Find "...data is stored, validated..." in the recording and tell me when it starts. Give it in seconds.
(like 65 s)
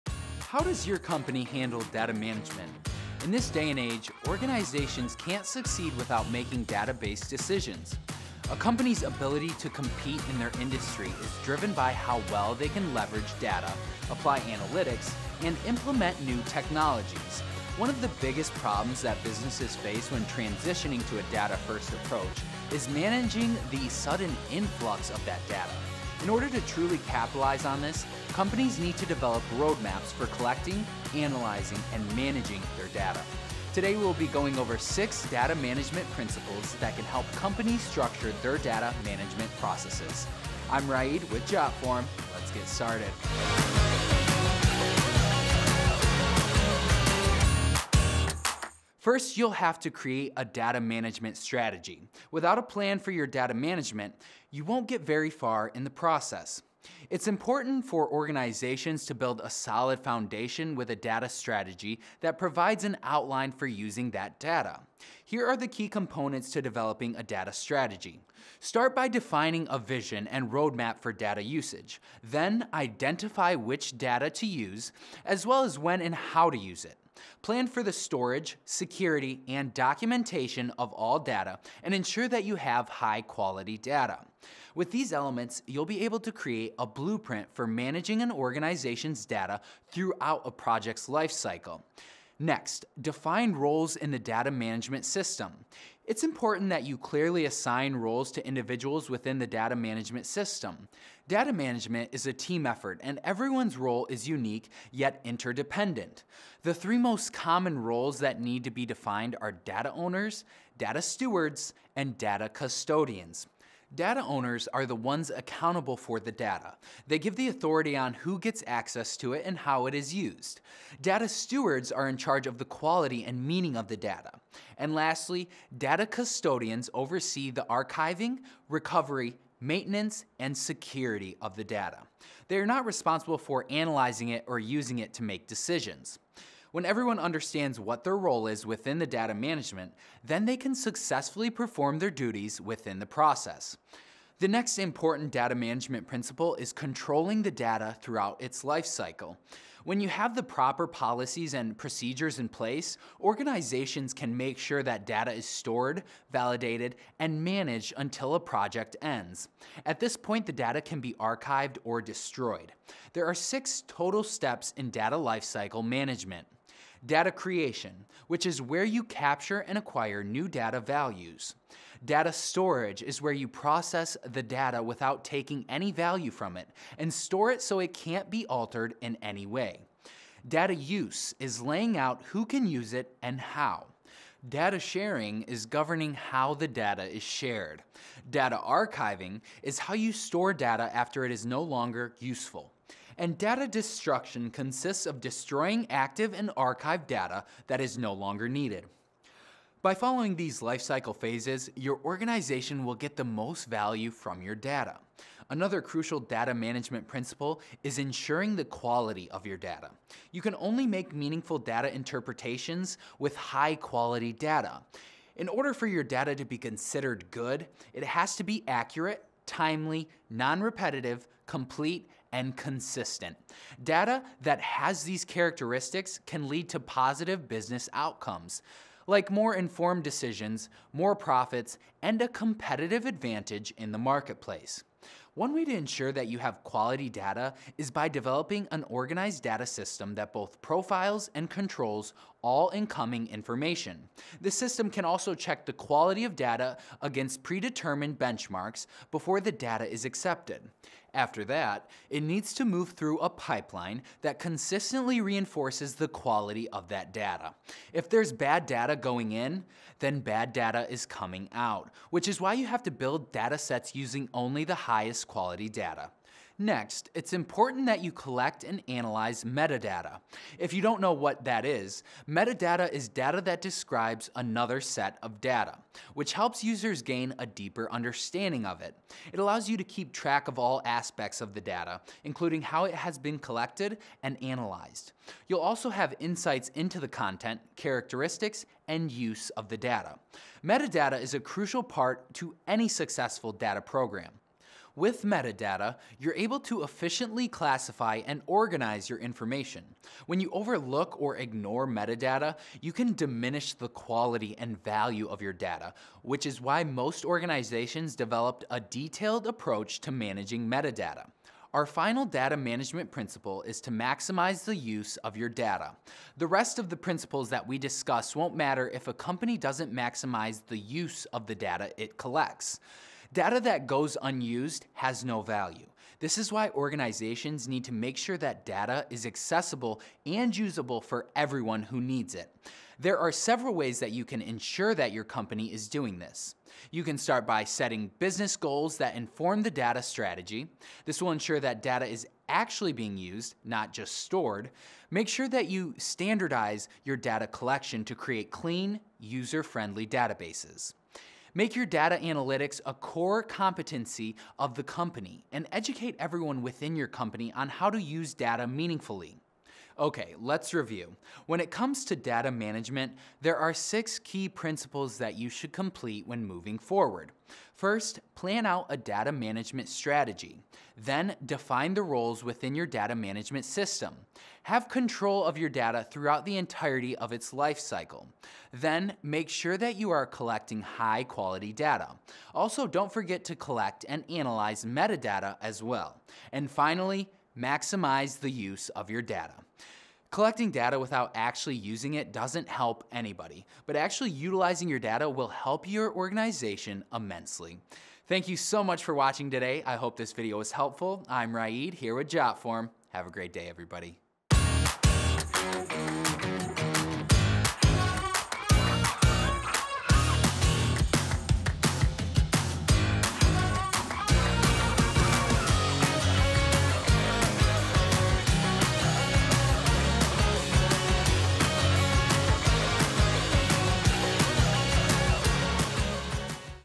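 155 s.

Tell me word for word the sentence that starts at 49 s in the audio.
First, you'll have to create a data management strategy.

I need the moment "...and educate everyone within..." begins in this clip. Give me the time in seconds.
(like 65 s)
355 s.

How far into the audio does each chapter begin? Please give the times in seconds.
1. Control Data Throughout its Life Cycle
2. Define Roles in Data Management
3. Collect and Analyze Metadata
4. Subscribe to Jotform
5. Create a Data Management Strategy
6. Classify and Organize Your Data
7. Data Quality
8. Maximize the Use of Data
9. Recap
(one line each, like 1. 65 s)
1. 146 s
2. 93 s
3. 267 s
4. 400 s
5. 48 s
6. 295 s
7. 205 s
8. 312 s
9. 365 s.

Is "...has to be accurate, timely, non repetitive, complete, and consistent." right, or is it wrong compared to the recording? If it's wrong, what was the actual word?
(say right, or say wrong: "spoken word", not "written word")
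right.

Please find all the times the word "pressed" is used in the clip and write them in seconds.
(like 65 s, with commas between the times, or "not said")
not said.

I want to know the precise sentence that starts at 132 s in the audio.
They are not responsible for analyzing it or using it to make decisions.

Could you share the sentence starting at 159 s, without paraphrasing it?
At this point, the data can be archived or destroyed.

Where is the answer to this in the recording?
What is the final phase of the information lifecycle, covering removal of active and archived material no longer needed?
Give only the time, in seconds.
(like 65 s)
193 s.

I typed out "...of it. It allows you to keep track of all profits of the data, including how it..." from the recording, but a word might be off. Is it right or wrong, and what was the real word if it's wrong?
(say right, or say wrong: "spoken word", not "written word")
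wrong: "aspects", not "profits".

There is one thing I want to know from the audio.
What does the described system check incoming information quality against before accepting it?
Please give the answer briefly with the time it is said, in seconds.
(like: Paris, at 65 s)
Predetermined benchmarks, at 247 s.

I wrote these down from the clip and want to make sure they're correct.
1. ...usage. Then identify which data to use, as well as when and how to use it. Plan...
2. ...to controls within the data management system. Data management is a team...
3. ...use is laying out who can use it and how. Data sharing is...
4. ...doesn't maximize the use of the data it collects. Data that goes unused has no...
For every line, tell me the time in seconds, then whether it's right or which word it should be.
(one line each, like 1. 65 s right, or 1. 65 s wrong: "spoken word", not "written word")
1. 71 s right
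2. 98 s wrong: "individuals", not "controls"
3. 180 s right
4. 319 s right.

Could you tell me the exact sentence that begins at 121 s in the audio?
Data stewards are in charge of the quality and meaning of the data.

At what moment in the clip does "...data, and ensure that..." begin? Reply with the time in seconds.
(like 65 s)
81 s.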